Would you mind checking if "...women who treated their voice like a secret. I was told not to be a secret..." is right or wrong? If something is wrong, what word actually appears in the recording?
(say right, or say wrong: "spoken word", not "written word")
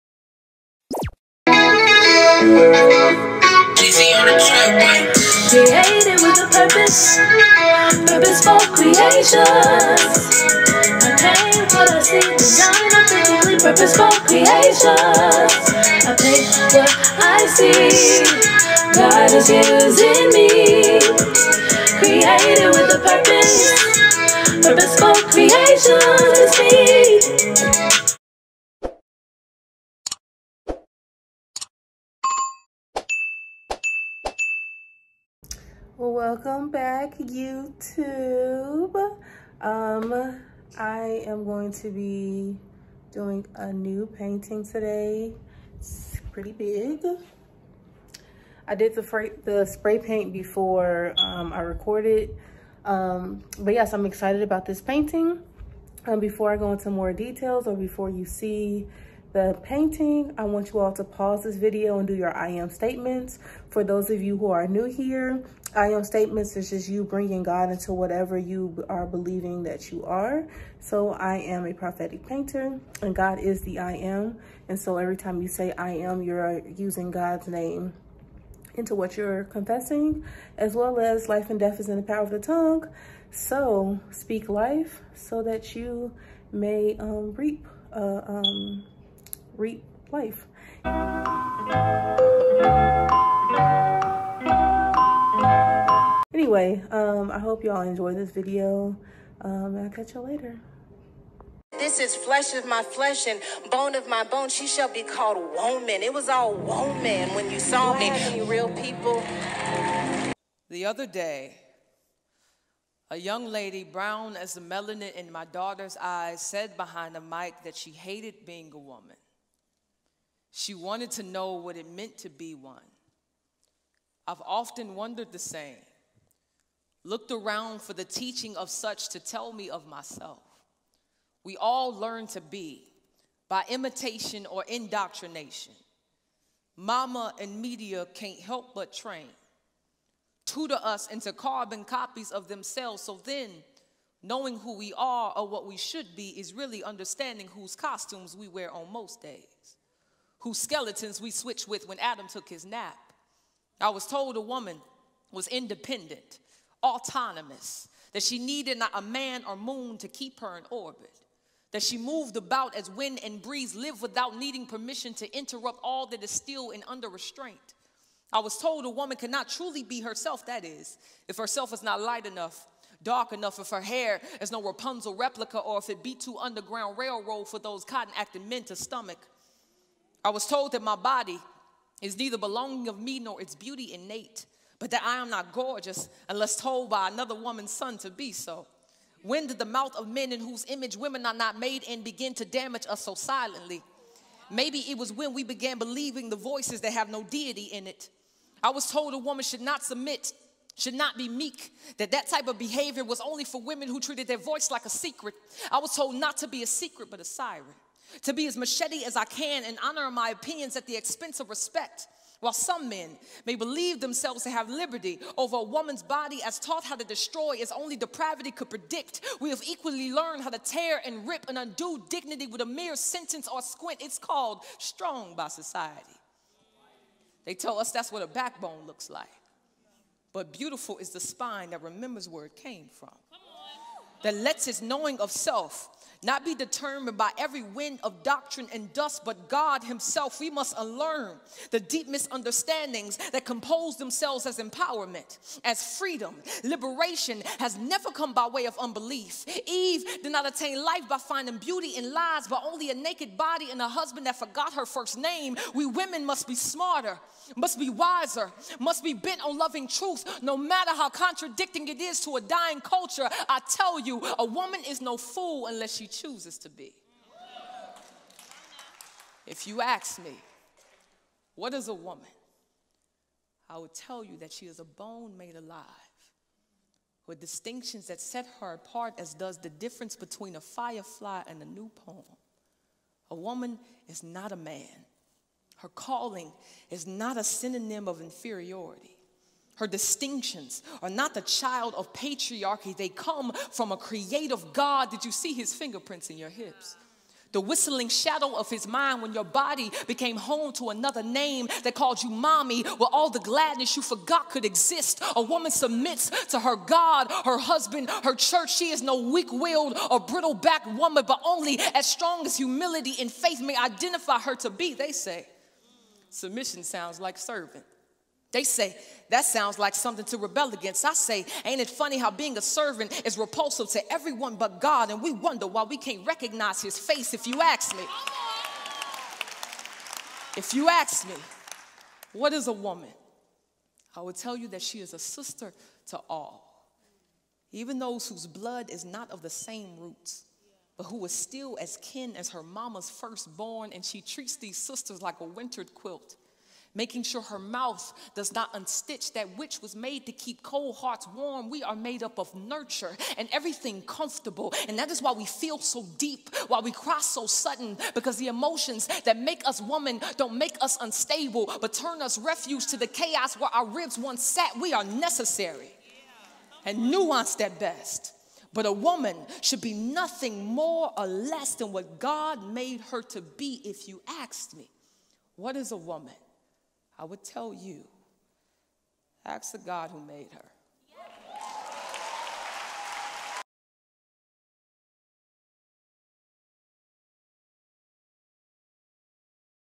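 right.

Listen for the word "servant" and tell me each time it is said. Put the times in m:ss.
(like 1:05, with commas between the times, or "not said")
5:17, 5:22.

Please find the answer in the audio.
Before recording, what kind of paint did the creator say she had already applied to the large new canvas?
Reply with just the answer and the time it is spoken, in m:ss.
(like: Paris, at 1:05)
Spray paint, at 0:49.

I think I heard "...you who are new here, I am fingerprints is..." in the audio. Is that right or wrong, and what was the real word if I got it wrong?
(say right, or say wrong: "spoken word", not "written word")
wrong: "statements", not "fingerprints".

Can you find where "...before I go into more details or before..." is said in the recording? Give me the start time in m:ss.
0:56.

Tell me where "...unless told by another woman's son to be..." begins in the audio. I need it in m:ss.
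3:06.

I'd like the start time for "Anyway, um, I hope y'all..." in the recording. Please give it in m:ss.
1:36.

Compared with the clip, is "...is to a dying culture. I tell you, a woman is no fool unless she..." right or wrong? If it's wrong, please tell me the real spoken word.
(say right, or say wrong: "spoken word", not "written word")
right.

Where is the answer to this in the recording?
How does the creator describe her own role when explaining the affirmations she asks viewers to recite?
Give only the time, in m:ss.
1:11.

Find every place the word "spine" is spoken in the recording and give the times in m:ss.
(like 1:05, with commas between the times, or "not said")
3:51.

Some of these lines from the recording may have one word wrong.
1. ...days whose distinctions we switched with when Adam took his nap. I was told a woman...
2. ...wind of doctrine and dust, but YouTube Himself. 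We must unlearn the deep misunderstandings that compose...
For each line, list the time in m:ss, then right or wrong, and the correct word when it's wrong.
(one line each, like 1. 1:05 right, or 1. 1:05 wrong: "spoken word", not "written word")
1. 2:29 wrong: "skeletons", not "distinctions"
2. 3:57 wrong: "God", not "YouTube".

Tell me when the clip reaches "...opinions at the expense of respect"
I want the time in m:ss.
3:30.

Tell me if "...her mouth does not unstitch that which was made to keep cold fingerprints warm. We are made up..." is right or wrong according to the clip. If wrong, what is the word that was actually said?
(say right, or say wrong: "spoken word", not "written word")
wrong: "hearts", not "fingerprints".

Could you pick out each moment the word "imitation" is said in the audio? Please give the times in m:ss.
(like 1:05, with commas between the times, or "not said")
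2:13.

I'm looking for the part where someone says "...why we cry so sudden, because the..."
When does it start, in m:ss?
5:56.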